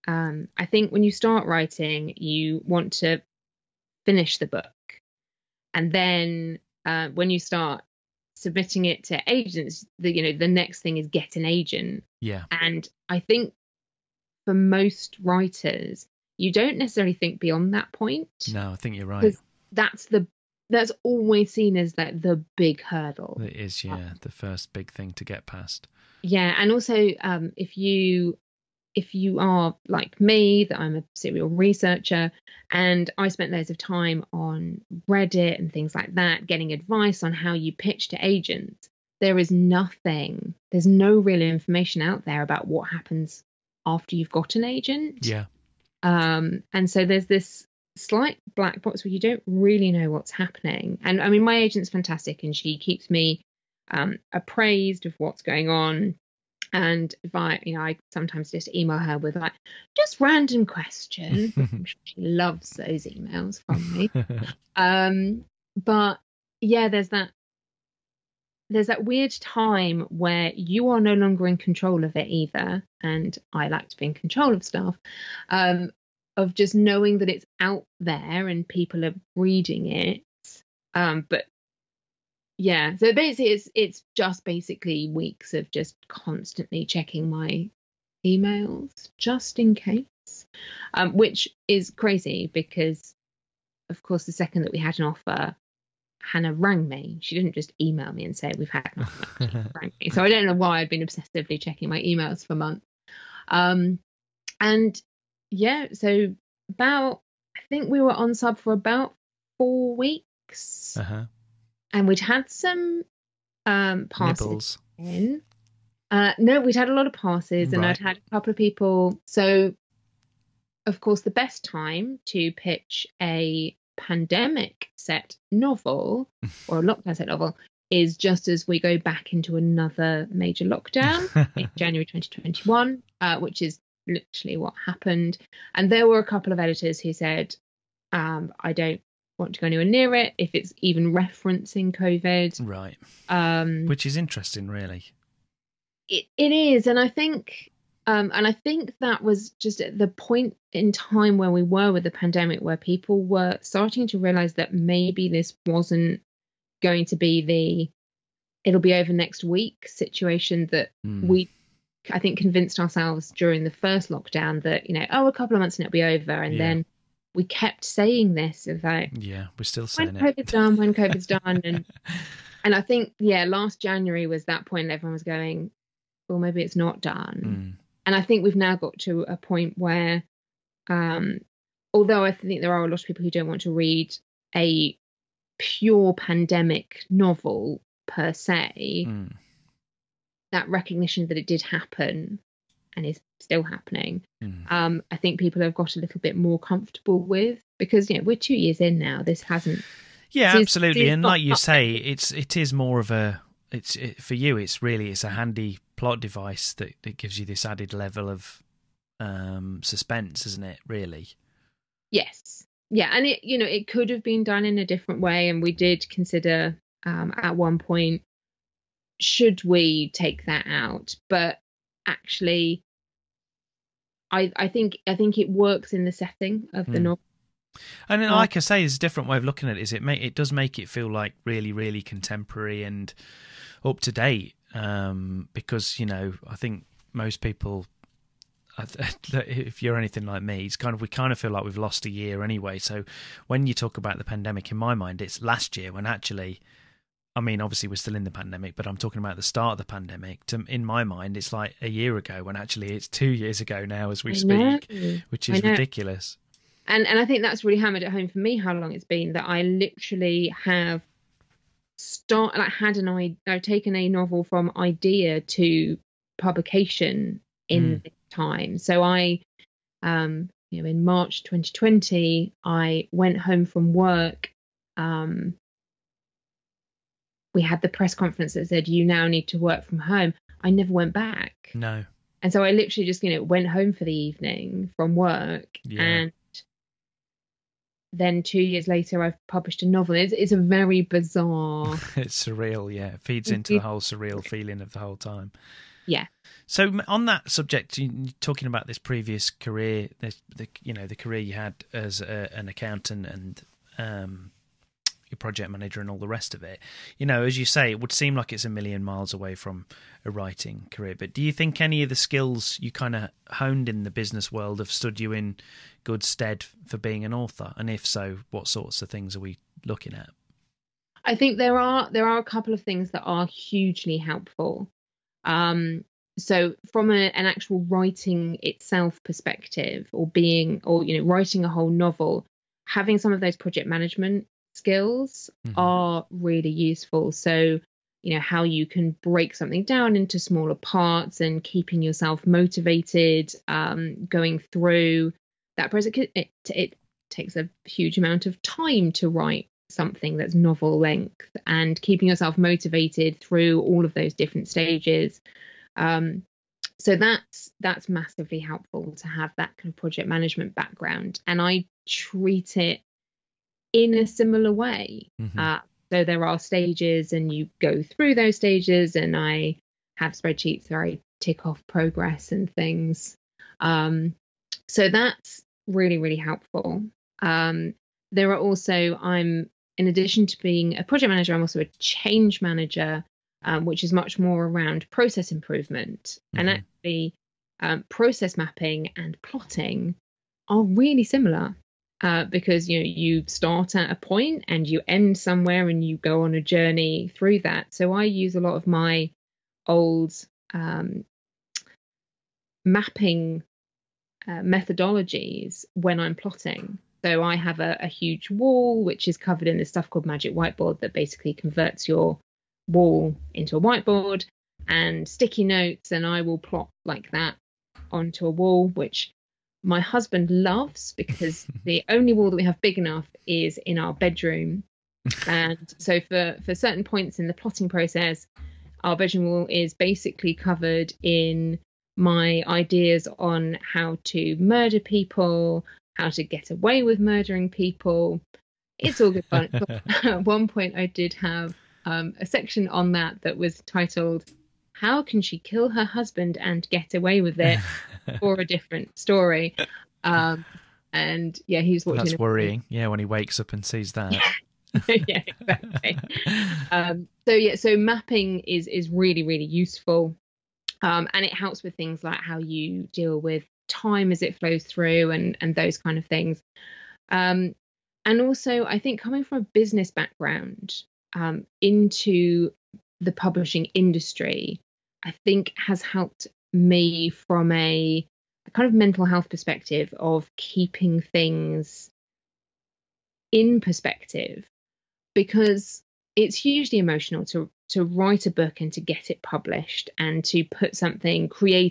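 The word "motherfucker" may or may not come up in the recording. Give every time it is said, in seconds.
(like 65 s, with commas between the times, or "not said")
not said.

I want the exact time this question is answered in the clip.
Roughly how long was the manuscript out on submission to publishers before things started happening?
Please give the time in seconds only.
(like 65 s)
108 s.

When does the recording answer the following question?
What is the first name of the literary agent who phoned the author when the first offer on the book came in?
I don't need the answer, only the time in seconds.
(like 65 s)
96 s.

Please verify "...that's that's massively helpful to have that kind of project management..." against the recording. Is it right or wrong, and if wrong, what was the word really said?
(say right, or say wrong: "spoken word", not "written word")
right.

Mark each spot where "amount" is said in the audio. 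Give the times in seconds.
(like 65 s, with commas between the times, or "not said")
348 s.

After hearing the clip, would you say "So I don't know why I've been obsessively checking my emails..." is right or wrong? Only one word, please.
right.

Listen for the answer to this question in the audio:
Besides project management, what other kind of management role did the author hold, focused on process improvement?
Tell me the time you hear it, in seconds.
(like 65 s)
381 s.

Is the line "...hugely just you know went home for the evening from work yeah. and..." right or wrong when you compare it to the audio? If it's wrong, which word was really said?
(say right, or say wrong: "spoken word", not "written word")
wrong: "literally", not "hugely".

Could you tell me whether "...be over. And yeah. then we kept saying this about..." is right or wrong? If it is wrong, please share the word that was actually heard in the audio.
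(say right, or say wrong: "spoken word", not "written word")
right.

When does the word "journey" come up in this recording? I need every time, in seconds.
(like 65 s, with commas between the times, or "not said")
396 s.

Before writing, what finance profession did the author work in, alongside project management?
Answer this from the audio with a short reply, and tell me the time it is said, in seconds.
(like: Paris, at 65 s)
accountant, at 302 s.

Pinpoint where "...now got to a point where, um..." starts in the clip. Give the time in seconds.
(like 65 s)
178 s.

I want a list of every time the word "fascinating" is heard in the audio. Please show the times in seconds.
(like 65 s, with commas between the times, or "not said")
not said.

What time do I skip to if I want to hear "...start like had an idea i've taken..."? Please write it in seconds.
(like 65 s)
261 s.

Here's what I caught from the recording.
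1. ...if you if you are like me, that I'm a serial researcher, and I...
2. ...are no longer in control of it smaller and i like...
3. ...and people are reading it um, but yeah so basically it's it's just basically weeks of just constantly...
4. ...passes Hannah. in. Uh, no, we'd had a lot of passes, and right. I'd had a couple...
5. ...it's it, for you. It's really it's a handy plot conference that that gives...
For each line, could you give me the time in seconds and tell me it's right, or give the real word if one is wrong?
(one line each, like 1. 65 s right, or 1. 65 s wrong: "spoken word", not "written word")
1. 27 s right
2. 70 s wrong: "either", not "smaller"
3. 78 s right
4. 114 s wrong: "Nibbles", not "Hannah"
5. 203 s wrong: "device", not "conference".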